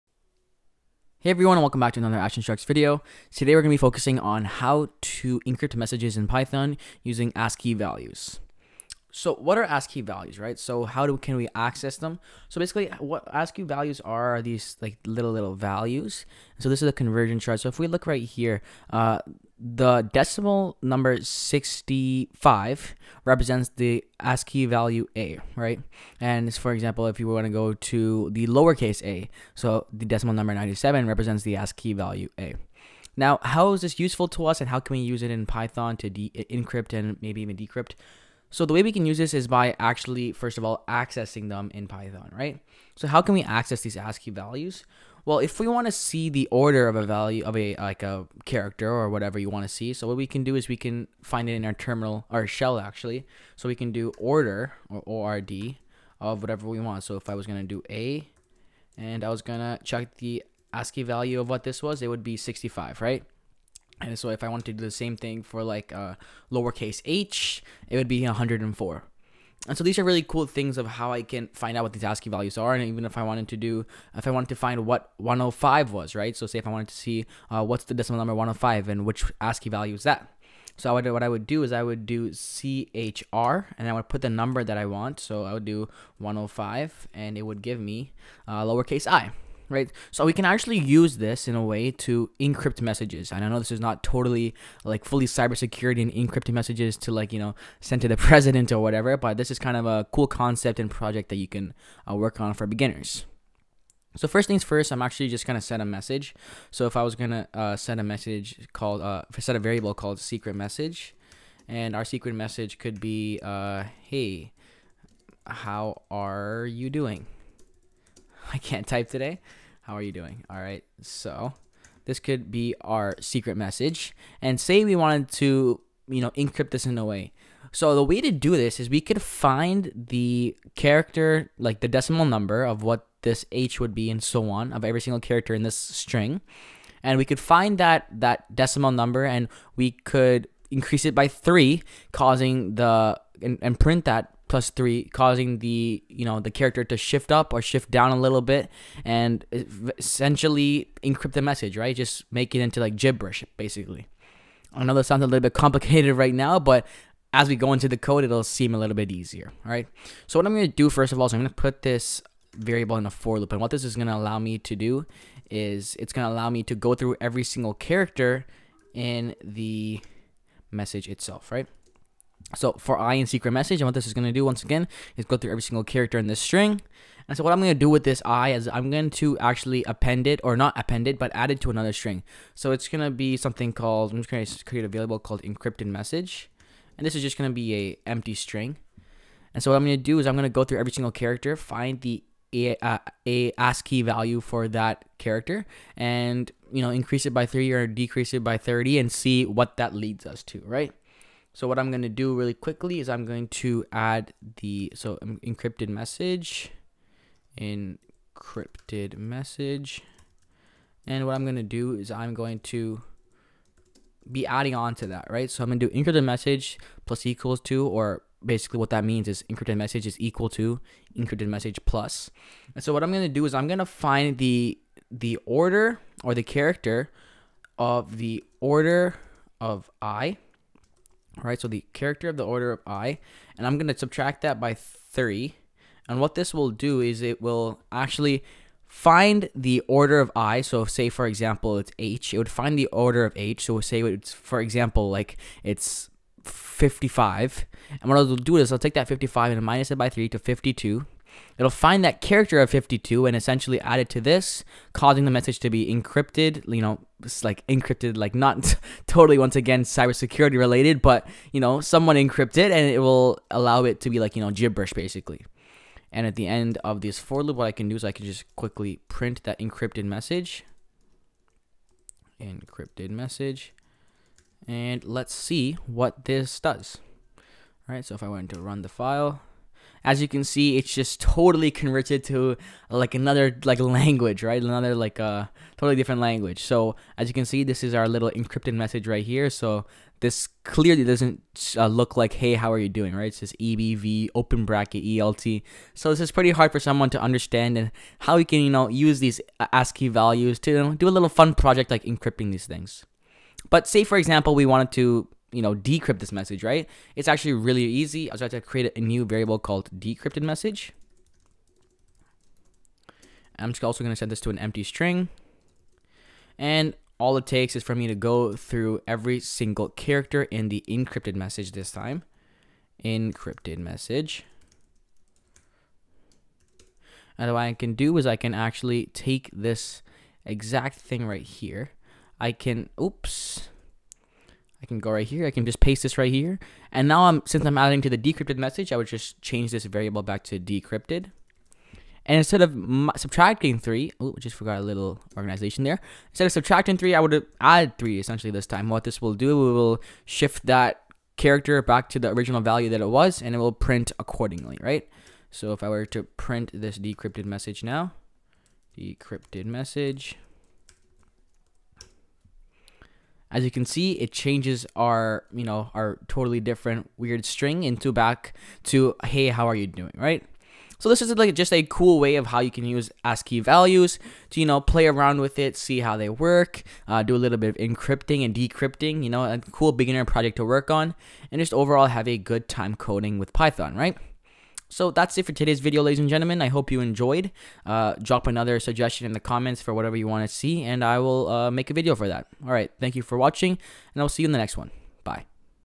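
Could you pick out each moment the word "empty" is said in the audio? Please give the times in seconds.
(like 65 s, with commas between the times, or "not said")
188 s, 314 s.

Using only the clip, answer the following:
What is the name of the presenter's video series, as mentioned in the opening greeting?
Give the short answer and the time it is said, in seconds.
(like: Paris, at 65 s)
Ash Instructs, at 2 s.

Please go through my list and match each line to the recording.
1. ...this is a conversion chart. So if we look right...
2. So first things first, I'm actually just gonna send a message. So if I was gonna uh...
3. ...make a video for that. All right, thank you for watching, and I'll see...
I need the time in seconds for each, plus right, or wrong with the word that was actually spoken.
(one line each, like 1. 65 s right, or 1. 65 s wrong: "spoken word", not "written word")
1. 16 s right
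2. 104 s right
3. 391 s right.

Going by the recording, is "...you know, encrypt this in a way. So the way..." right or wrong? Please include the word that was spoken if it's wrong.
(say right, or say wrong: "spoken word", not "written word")
right.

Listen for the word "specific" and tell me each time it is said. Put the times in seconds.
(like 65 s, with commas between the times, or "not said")
not said.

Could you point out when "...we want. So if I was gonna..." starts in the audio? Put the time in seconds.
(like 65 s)
56 s.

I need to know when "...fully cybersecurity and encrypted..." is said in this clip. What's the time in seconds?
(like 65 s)
95 s.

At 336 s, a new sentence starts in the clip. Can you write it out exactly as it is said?
And now I'm since I'm adding to the decrypted message, I would just change this variable back to decrypted.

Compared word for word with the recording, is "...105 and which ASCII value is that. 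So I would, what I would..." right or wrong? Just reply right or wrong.
right.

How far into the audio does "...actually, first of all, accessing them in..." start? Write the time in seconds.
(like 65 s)
39 s.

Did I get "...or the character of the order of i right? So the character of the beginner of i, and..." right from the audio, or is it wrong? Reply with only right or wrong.
wrong.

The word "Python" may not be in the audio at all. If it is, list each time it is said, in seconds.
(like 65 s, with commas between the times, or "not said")
6 s, 35 s, 41 s, 383 s.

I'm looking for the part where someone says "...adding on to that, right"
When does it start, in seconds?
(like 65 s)
214 s.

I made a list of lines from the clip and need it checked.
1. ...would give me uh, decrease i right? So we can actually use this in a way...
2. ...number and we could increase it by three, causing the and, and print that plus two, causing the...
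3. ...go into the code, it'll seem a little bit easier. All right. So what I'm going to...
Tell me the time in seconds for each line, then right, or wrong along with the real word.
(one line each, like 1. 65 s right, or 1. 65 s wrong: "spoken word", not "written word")
1. 87 s wrong: "lowercase", not "decrease"
2. 138 s wrong: "three", not "two"
3. 157 s right.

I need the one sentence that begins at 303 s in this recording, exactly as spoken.
But say, for example, we wanted to you know, decrypt this message, right?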